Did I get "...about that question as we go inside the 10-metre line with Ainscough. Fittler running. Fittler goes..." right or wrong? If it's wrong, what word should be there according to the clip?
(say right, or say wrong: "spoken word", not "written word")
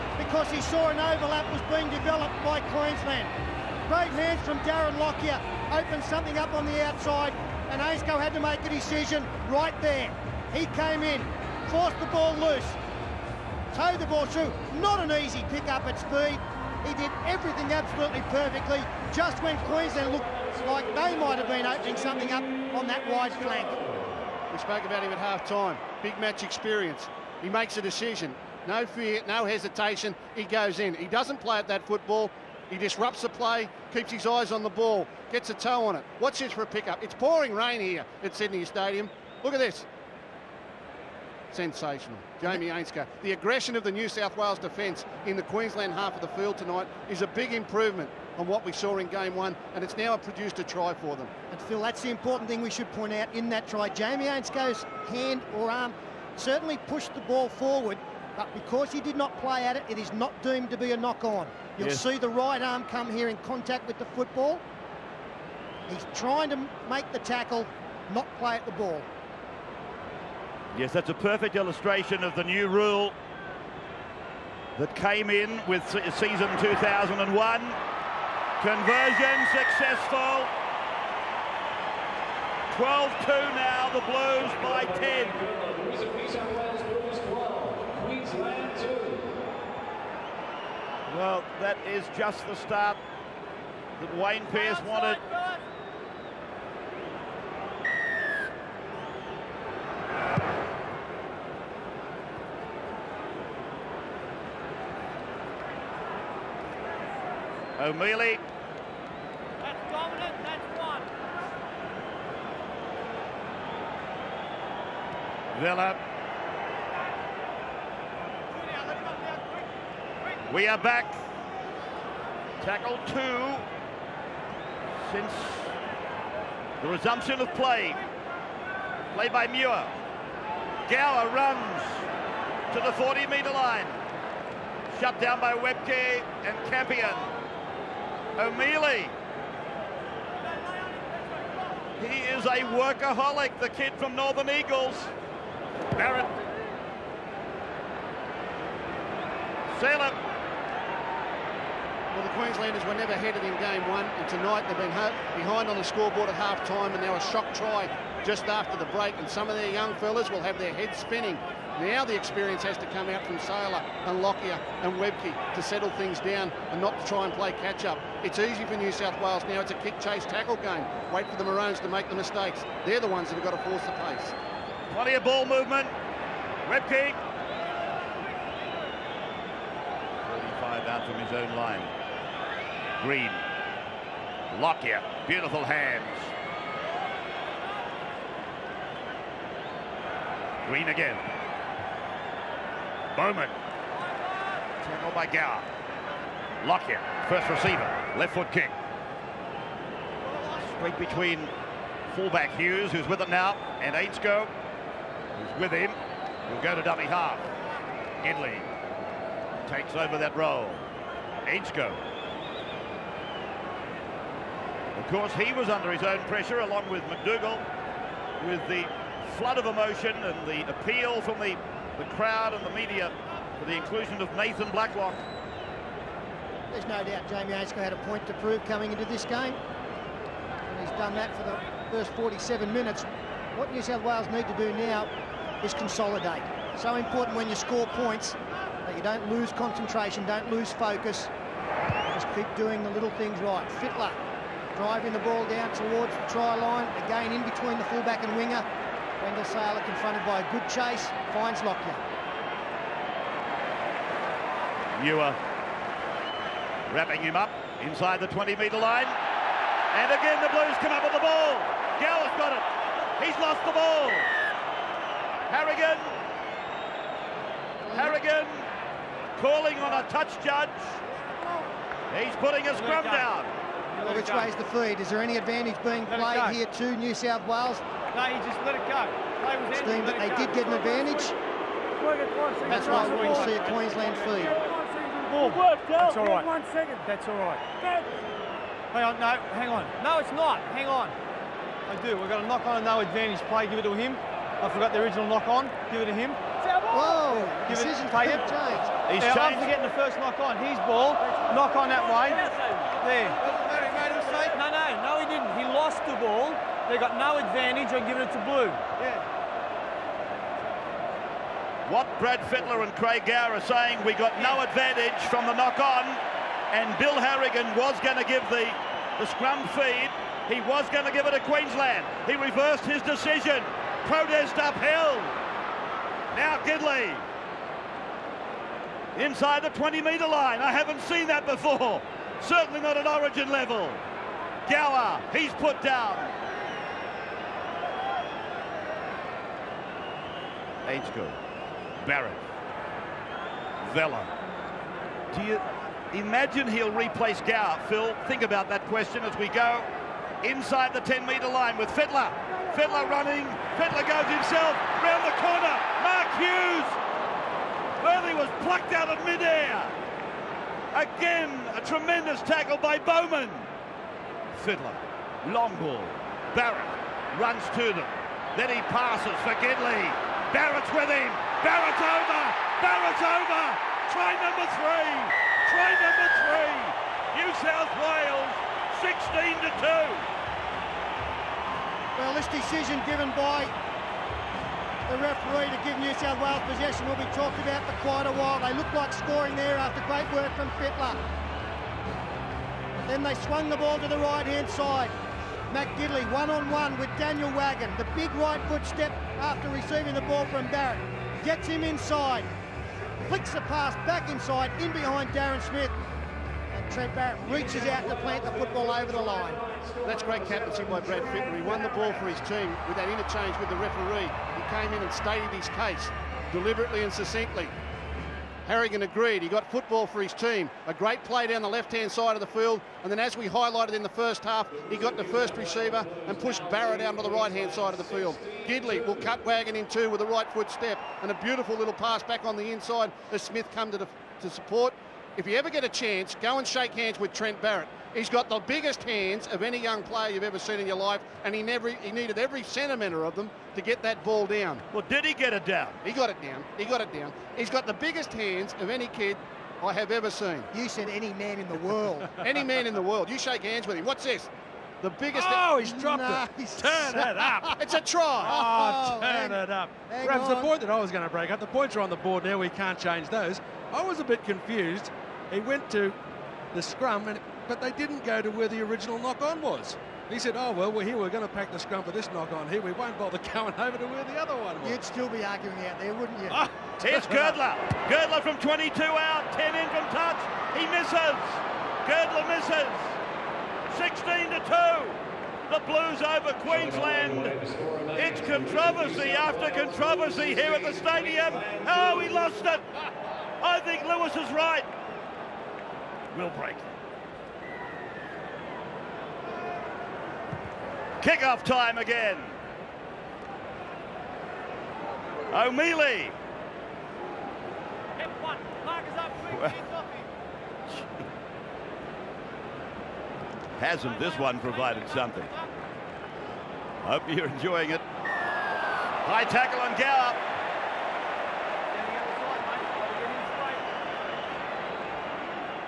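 wrong: "Fittler", not "Ainscough".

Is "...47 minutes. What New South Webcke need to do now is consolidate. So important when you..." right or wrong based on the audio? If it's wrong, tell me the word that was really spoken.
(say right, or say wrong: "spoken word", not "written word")
wrong: "Wales", not "Webcke".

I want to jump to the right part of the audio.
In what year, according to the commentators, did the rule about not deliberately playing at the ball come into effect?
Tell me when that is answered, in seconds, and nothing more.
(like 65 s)
76 s.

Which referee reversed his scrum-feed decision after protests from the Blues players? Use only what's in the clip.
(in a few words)
Bill Harrigan.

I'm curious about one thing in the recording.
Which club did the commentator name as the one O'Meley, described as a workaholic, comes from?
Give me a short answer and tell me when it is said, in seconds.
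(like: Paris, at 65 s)
Northern Eagles, at 144 s.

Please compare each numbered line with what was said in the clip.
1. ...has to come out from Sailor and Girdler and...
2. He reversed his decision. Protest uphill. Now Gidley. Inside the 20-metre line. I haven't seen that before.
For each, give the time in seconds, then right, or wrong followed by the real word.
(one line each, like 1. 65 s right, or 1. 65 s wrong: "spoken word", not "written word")
1. 162 s wrong: "Lockyer", not "Girdler"
2. 322 s right.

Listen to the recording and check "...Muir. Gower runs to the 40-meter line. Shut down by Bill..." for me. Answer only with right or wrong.
wrong.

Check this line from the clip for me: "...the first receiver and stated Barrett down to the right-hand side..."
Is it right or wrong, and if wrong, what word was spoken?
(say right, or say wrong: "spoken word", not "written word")
wrong: "pushed", not "stated".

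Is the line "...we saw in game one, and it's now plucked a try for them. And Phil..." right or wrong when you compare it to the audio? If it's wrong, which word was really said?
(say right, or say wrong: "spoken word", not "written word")
wrong: "produced", not "plucked".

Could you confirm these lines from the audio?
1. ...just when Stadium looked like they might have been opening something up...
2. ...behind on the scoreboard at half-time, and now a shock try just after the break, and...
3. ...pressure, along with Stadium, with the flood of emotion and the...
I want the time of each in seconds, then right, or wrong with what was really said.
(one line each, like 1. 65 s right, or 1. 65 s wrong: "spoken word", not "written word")
1. 19 s wrong: "Queensland", not "Stadium"
2. 155 s right
3. 216 s wrong: "MacDougall", not "Stadium".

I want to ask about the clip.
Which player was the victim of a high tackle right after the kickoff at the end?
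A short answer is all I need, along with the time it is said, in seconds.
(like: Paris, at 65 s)
Gallup, at 519 s.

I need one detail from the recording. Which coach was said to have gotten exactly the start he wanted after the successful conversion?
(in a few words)
Wayne Pearce.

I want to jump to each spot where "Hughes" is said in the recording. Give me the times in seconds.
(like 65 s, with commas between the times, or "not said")
202 s, 356 s.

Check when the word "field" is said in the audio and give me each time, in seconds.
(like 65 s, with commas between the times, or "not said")
46 s, 422 s, 428 s.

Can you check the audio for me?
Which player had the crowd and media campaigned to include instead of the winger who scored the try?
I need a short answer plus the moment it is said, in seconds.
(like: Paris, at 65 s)
Nathan Blacklock, at 224 s.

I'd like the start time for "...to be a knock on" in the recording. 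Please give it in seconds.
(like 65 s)
60 s.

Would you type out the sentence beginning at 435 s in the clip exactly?
If you ever get a chance, go and shake hands with Trent Barrett.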